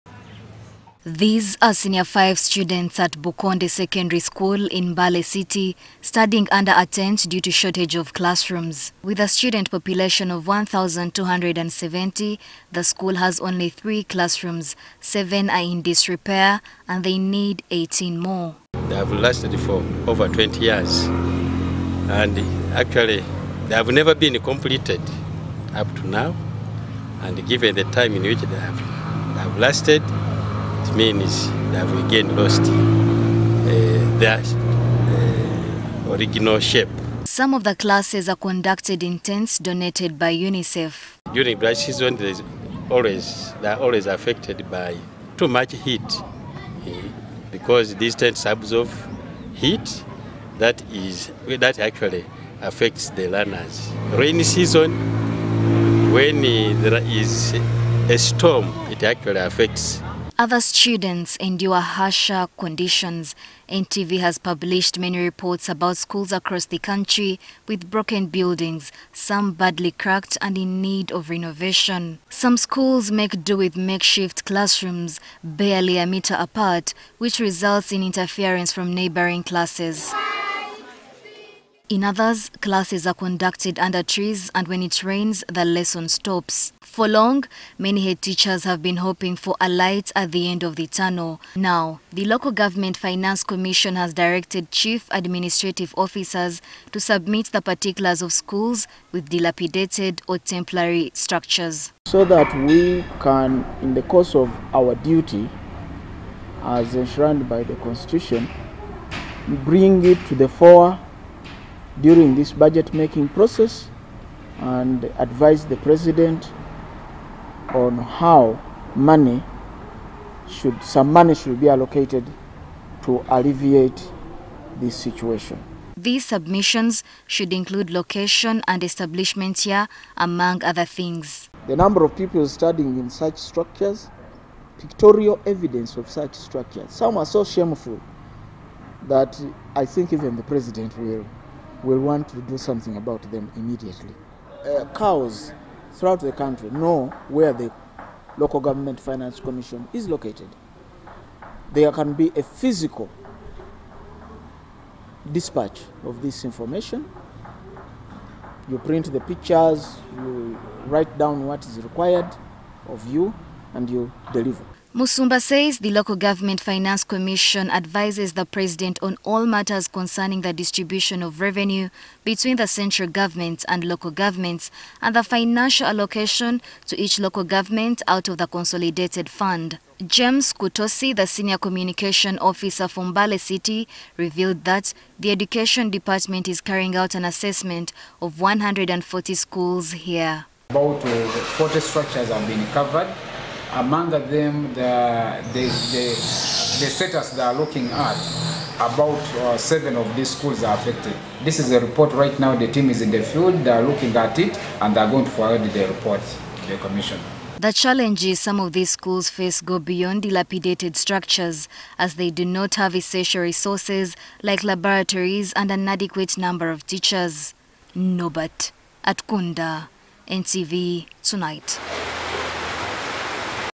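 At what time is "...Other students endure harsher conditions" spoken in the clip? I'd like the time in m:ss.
1:00.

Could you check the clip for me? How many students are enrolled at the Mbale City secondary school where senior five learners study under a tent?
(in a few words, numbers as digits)
1,270.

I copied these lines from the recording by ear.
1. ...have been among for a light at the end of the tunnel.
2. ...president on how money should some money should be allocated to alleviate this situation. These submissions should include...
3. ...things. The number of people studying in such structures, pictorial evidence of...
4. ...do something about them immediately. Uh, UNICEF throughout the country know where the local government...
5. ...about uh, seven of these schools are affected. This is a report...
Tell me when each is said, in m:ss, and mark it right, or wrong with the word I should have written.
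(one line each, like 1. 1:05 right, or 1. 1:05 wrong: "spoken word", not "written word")
1. 1:28 wrong: "hoping", not "among"
2. 1:55 right
3. 2:10 right
4. 2:22 wrong: "CAOs", not "UNICEF"
5. 3:18 right.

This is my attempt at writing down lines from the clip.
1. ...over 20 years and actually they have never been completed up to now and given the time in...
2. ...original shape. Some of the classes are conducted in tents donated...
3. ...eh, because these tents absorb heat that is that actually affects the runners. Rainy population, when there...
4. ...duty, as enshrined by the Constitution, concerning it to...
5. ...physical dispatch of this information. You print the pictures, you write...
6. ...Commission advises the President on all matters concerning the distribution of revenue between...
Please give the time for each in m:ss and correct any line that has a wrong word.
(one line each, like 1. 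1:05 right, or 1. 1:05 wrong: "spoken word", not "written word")
1. 0:20 right
2. 0:36 right
3. 0:46 wrong: "season", not "population"
4. 1:44 wrong: "bring", not "concerning"
5. 2:32 right
6. 2:47 right.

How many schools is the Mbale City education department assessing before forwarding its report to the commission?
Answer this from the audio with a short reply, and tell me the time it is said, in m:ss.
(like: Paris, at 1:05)
140, at 3:08.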